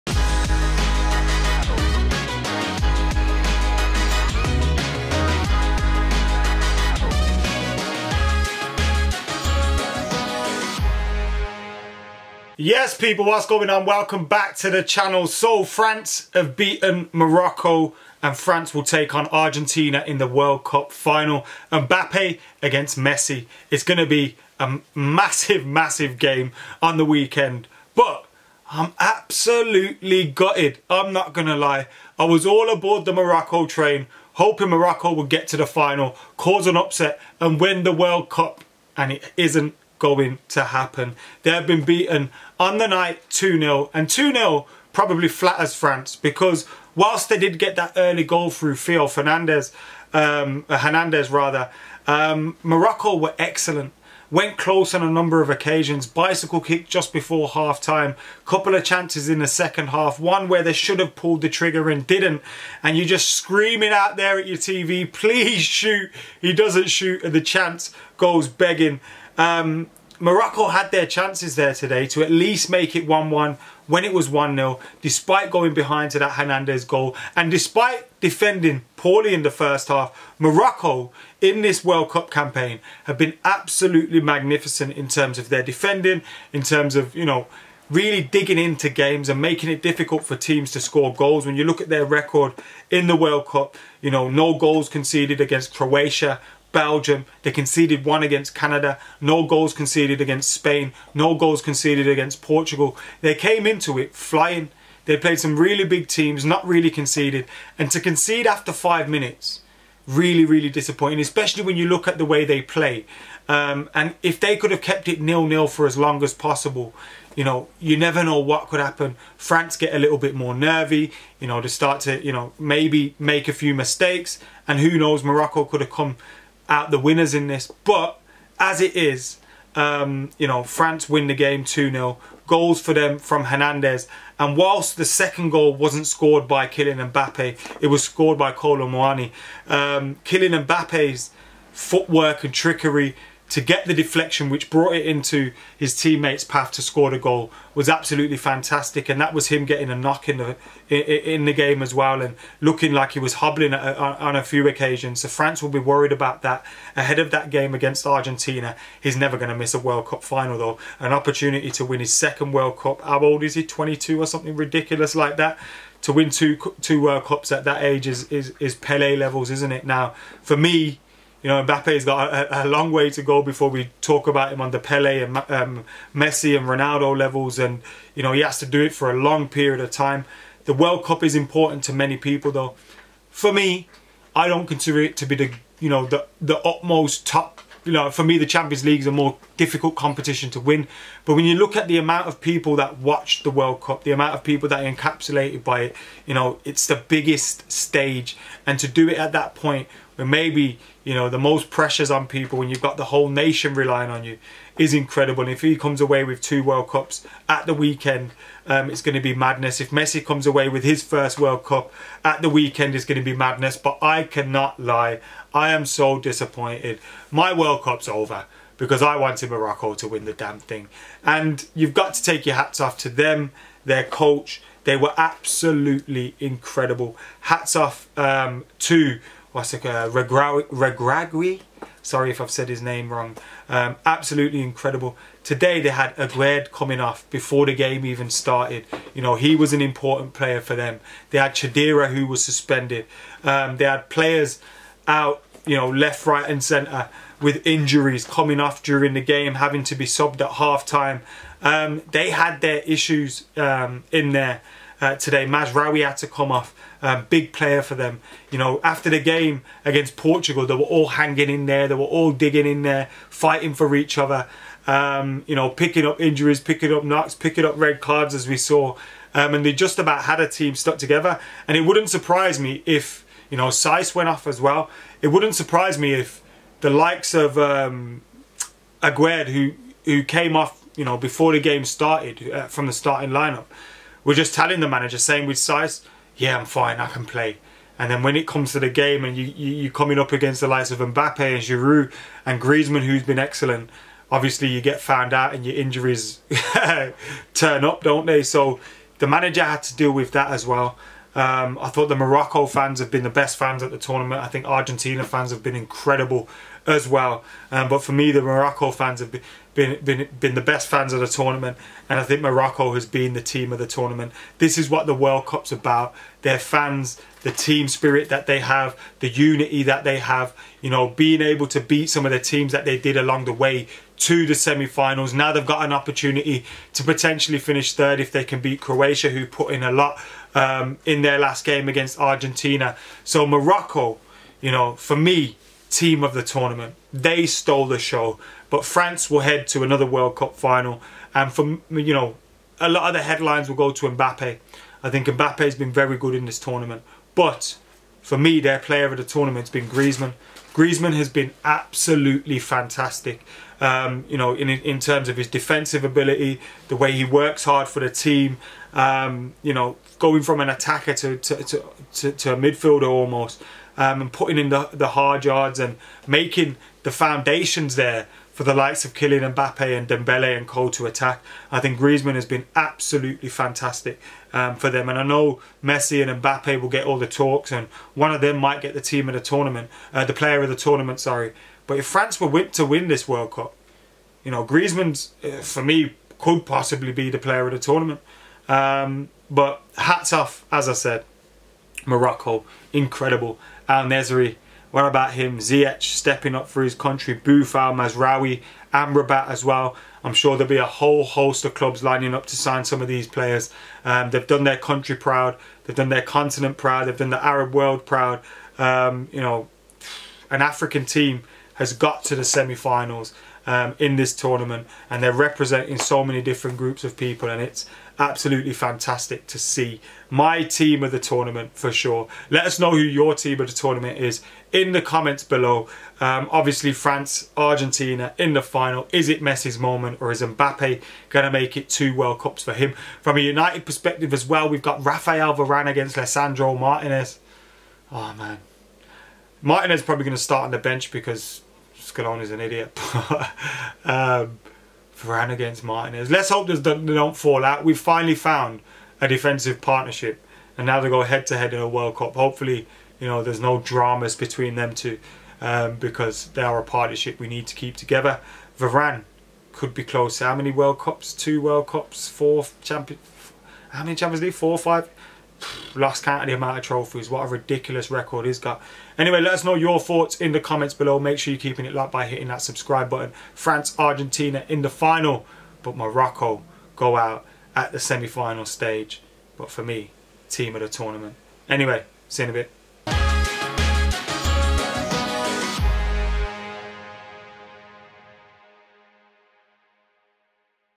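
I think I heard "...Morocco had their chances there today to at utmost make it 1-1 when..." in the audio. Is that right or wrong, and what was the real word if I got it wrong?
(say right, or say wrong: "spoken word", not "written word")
wrong: "least", not "utmost".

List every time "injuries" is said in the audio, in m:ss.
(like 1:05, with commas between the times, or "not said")
4:07, 4:26, 4:55.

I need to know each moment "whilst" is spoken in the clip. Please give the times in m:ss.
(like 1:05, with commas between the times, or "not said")
0:46, 2:14.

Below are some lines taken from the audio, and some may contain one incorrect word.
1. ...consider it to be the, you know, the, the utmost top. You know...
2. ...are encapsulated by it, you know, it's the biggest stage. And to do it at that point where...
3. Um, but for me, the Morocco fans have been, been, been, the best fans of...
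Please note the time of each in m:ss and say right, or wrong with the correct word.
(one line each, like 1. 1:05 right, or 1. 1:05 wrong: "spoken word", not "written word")
1. 3:04 right
2. 3:14 right
3. 5:07 right.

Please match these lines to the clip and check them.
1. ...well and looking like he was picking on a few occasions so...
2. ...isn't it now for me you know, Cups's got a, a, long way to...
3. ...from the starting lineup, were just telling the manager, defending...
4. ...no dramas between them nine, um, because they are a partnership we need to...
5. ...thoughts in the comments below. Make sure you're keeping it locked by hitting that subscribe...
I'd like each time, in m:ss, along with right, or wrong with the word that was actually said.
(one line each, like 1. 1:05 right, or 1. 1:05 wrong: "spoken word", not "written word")
1. 2:31 wrong: "hobbling", not "picking"
2. 2:49 wrong: "Mbappe", not "Cups"
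3. 4:42 wrong: "saying", not "defending"
4. 7:33 wrong: "two", not "nine"
5. 7:49 right.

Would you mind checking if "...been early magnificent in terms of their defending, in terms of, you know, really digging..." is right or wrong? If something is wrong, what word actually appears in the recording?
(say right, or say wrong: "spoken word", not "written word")
wrong: "absolutely", not "early".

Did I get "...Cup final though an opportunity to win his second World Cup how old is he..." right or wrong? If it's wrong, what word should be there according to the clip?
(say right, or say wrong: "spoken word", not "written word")
right.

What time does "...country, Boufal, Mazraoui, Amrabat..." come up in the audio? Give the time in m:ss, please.
6:36.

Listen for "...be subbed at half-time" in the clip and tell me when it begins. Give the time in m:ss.
4:09.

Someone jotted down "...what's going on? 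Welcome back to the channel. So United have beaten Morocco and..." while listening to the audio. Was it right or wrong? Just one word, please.
wrong.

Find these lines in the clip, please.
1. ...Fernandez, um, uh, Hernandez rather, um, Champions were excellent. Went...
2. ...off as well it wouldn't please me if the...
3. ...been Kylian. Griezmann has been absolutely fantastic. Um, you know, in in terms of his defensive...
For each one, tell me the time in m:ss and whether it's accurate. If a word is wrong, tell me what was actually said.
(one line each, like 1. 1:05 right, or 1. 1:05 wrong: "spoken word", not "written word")
1. 0:49 wrong: "Morocco", not "Champions"
2. 4:34 wrong: "surprise", not "please"
3. 5:49 wrong: "Griezmann", not "Kylian".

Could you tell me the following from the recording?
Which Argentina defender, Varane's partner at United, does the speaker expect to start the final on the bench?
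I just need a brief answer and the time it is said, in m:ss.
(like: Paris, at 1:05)
Lisandro Martinez, at 7:16.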